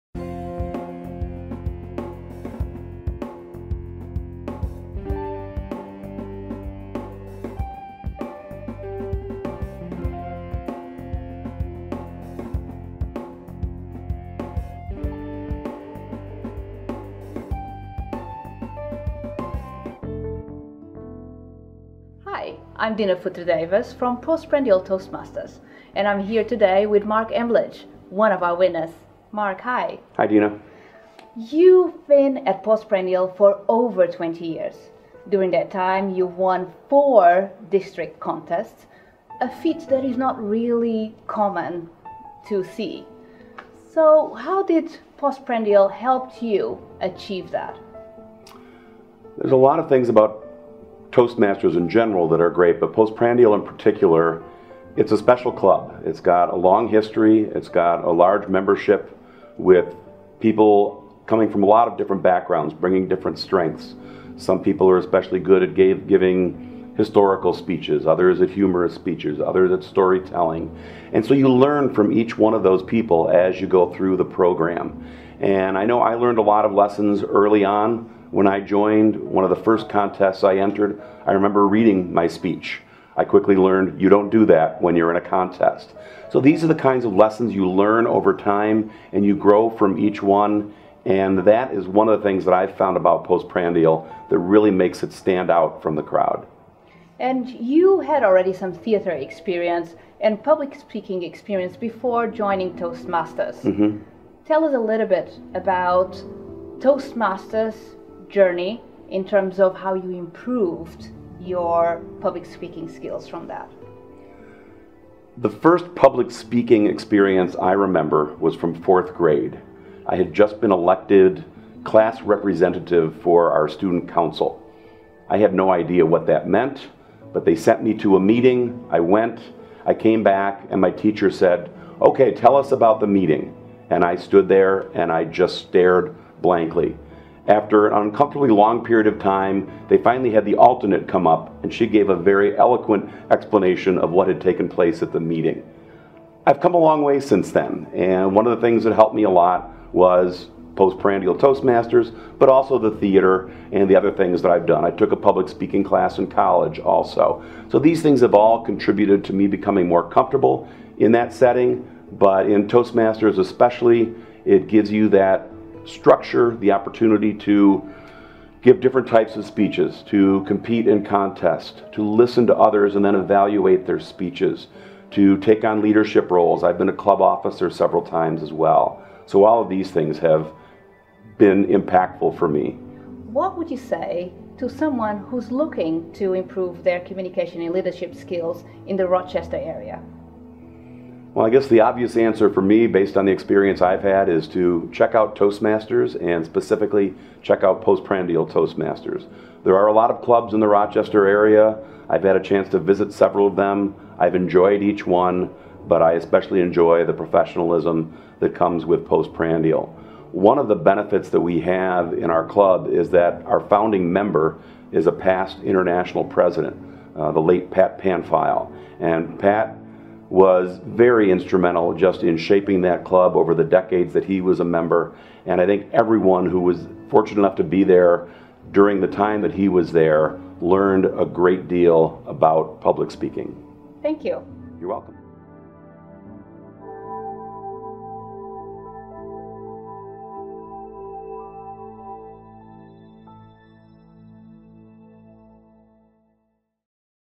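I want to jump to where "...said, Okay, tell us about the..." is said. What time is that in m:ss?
2:11.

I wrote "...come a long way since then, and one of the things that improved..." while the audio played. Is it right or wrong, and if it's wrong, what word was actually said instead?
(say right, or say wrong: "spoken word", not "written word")
wrong: "helped", not "improved".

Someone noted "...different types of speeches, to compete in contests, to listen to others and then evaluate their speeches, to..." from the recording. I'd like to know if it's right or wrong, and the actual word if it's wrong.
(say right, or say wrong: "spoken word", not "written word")
right.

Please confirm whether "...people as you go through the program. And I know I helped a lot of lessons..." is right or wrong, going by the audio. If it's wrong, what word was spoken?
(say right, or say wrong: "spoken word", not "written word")
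wrong: "learned", not "helped".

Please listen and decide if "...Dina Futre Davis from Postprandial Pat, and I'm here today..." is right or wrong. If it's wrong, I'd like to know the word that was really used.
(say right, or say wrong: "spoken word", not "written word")
wrong: "Toastmasters", not "Pat".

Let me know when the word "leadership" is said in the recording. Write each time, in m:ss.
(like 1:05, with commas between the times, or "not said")
2:55, 3:07.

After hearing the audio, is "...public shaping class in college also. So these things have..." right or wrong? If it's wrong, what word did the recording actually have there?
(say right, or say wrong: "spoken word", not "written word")
wrong: "speaking", not "shaping".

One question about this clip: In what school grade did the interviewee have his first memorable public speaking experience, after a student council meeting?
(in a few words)
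Fourth grade.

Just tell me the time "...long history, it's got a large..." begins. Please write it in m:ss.
0:56.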